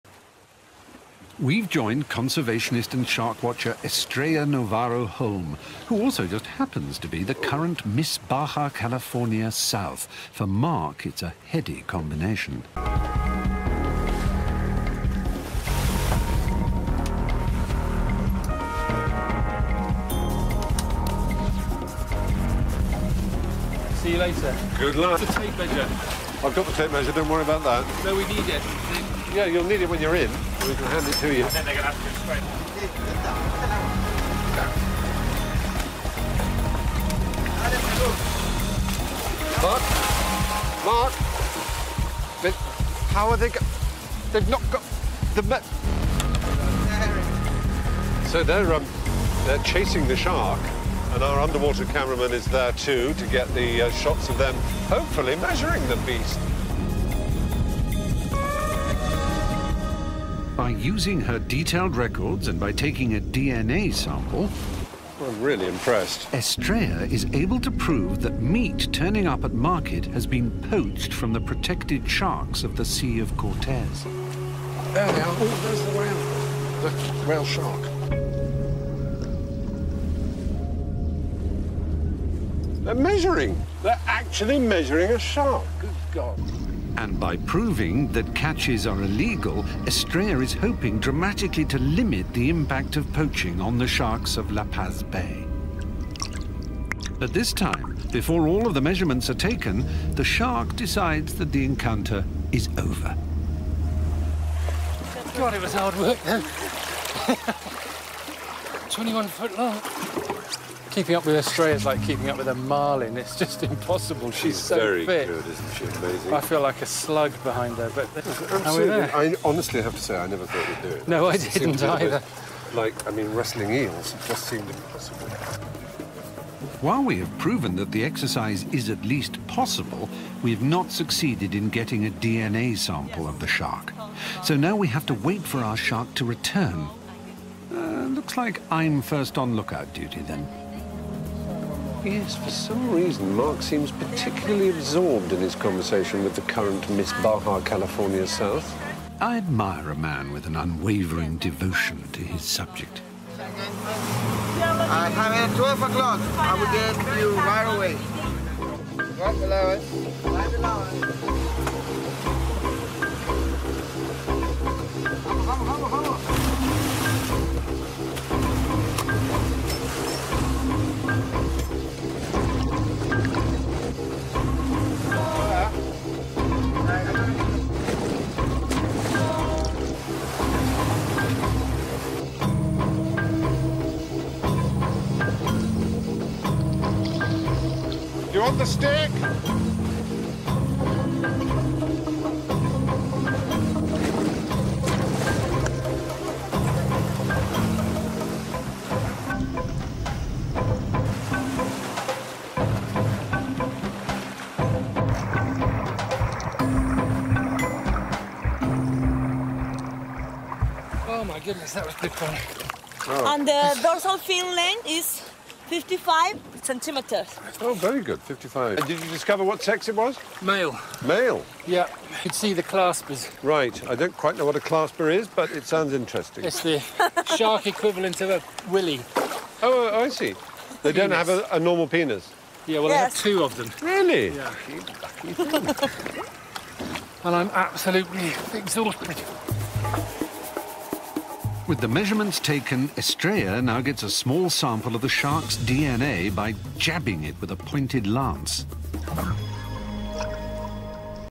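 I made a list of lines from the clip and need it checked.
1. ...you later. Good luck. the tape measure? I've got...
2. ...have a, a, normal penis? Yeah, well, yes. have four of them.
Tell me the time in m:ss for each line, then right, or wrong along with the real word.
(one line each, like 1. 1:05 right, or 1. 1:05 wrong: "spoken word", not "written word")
1. 0:24 right
2. 3:51 wrong: "two", not "four".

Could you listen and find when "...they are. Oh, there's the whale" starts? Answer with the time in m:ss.
1:14.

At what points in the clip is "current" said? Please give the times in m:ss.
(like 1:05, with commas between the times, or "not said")
0:07, 2:26.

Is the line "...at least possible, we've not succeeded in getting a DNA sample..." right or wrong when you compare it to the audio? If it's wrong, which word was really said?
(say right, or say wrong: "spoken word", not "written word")
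right.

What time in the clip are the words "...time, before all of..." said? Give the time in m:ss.
1:37.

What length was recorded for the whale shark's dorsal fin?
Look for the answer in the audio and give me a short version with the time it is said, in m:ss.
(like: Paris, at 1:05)
55 centimeters, at 3:35.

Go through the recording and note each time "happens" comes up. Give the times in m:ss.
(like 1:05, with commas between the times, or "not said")
0:06.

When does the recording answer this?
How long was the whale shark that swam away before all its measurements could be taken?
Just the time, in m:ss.
1:48.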